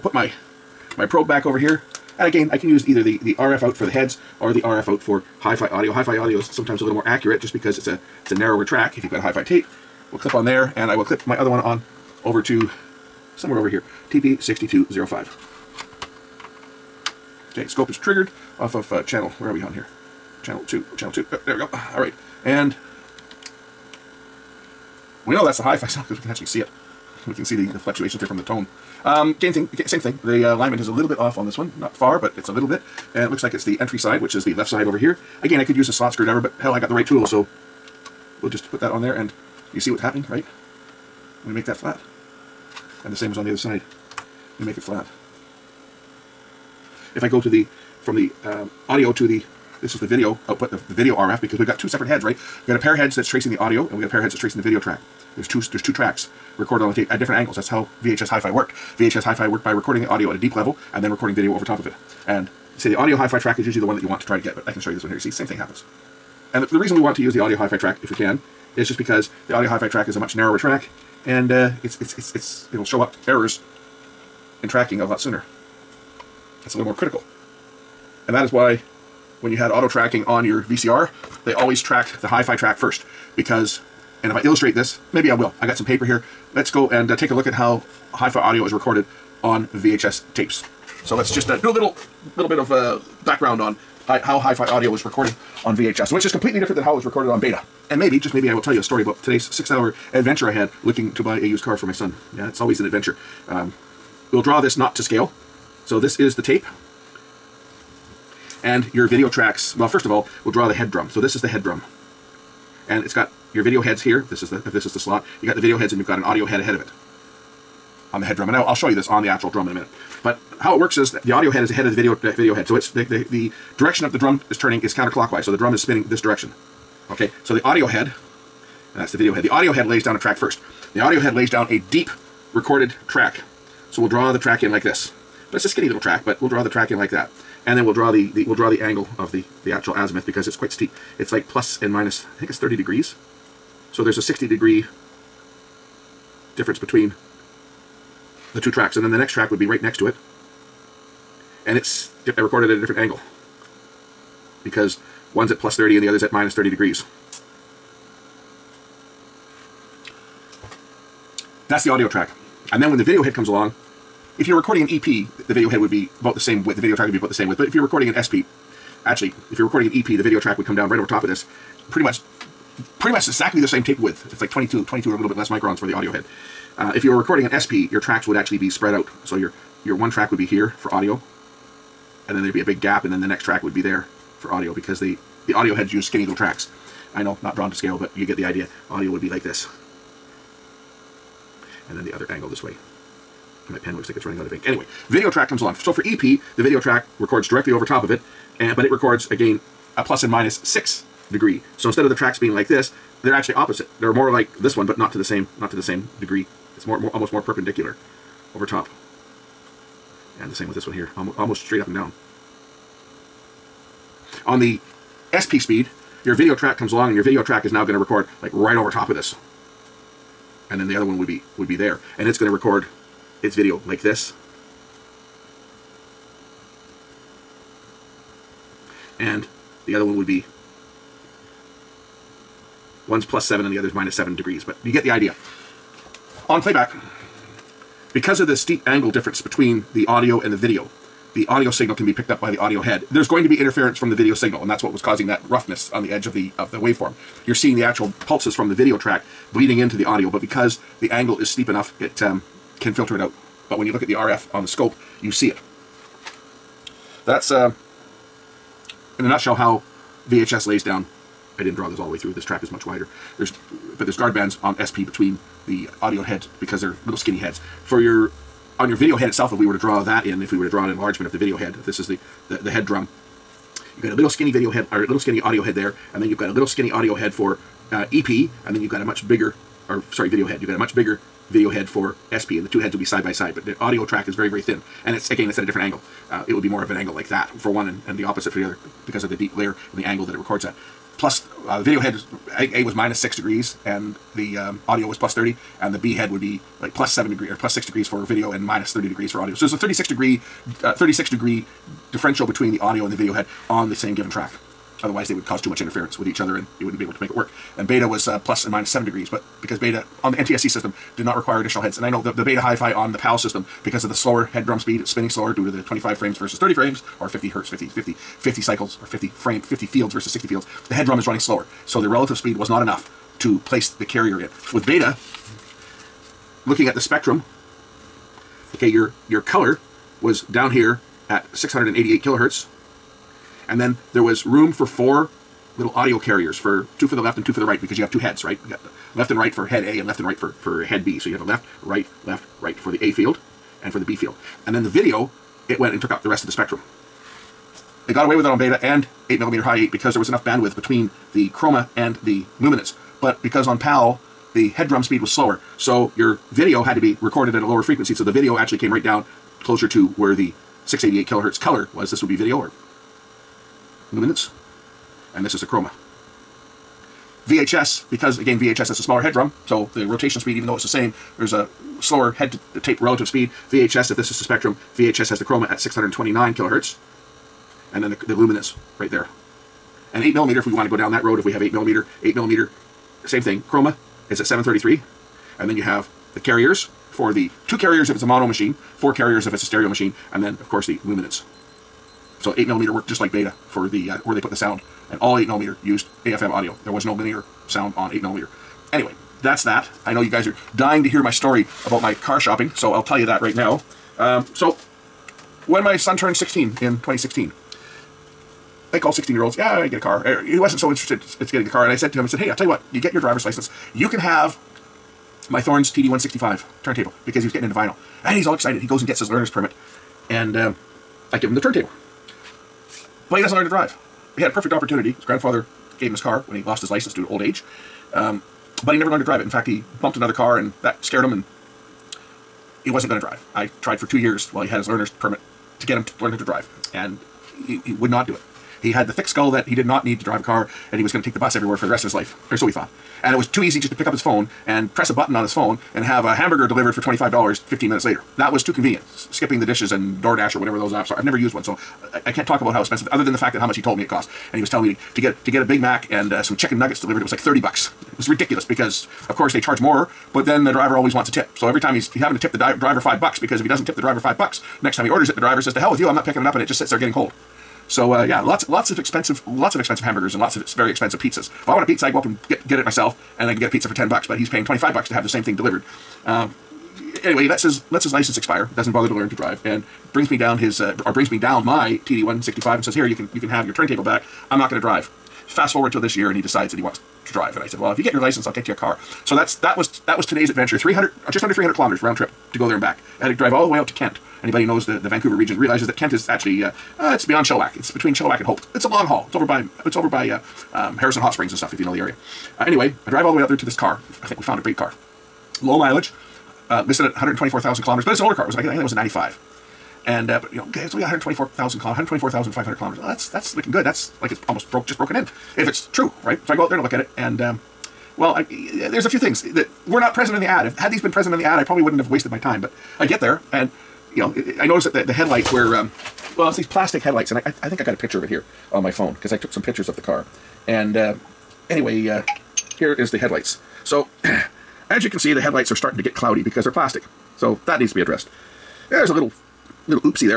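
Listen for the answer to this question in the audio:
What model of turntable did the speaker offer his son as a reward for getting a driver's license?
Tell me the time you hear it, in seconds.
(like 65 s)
415 s.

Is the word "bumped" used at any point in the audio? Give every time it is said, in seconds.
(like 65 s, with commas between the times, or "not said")
430 s.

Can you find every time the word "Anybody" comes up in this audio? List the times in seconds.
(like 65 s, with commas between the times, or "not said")
494 s.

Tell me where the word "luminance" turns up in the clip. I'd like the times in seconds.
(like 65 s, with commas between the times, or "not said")
352 s, 364 s, 378 s, 391 s.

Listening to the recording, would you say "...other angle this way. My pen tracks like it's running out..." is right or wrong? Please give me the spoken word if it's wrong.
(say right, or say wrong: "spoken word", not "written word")
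wrong: "looks", not "tracks".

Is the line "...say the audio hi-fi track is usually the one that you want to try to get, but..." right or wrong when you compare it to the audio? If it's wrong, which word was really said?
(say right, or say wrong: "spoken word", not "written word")
right.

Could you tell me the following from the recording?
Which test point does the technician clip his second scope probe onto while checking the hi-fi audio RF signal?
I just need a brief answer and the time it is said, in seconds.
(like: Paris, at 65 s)
TP6205, at 14 s.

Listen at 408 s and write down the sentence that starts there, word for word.
I all 16 year olds, yeah, I get a car.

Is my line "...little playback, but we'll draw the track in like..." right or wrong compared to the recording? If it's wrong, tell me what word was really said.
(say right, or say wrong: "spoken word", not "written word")
wrong: "track", not "playback".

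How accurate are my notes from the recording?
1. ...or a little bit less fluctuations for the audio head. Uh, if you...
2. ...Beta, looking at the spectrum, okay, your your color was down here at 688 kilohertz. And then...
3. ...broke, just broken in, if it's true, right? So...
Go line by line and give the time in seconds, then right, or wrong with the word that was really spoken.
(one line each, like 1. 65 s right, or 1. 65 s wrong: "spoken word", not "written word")
1. 175 s wrong: "microns", not "fluctuations"
2. 324 s right
3. 514 s right.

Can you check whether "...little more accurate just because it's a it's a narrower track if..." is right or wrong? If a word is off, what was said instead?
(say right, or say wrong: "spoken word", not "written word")
right.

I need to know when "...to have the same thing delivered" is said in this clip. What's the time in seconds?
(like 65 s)
475 s.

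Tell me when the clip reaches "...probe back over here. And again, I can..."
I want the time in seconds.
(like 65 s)
1 s.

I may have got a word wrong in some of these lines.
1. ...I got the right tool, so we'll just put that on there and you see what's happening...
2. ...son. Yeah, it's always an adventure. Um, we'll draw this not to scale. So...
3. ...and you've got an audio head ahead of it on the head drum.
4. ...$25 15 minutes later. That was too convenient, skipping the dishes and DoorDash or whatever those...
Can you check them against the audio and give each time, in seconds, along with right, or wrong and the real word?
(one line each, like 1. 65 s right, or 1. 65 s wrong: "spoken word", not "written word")
1. 36 s right
2. 101 s right
3. 115 s right
4. 447 s right.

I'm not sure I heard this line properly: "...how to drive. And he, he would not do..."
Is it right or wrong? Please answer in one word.
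right.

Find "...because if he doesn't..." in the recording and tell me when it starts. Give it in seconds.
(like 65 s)
463 s.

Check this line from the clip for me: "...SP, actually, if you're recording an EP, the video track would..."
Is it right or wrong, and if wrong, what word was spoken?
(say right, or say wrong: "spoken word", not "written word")
right.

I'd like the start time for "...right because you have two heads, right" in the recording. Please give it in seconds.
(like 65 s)
337 s.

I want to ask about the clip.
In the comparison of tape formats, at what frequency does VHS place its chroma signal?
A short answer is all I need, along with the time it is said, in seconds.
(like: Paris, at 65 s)
629 kilohertz, at 375 s.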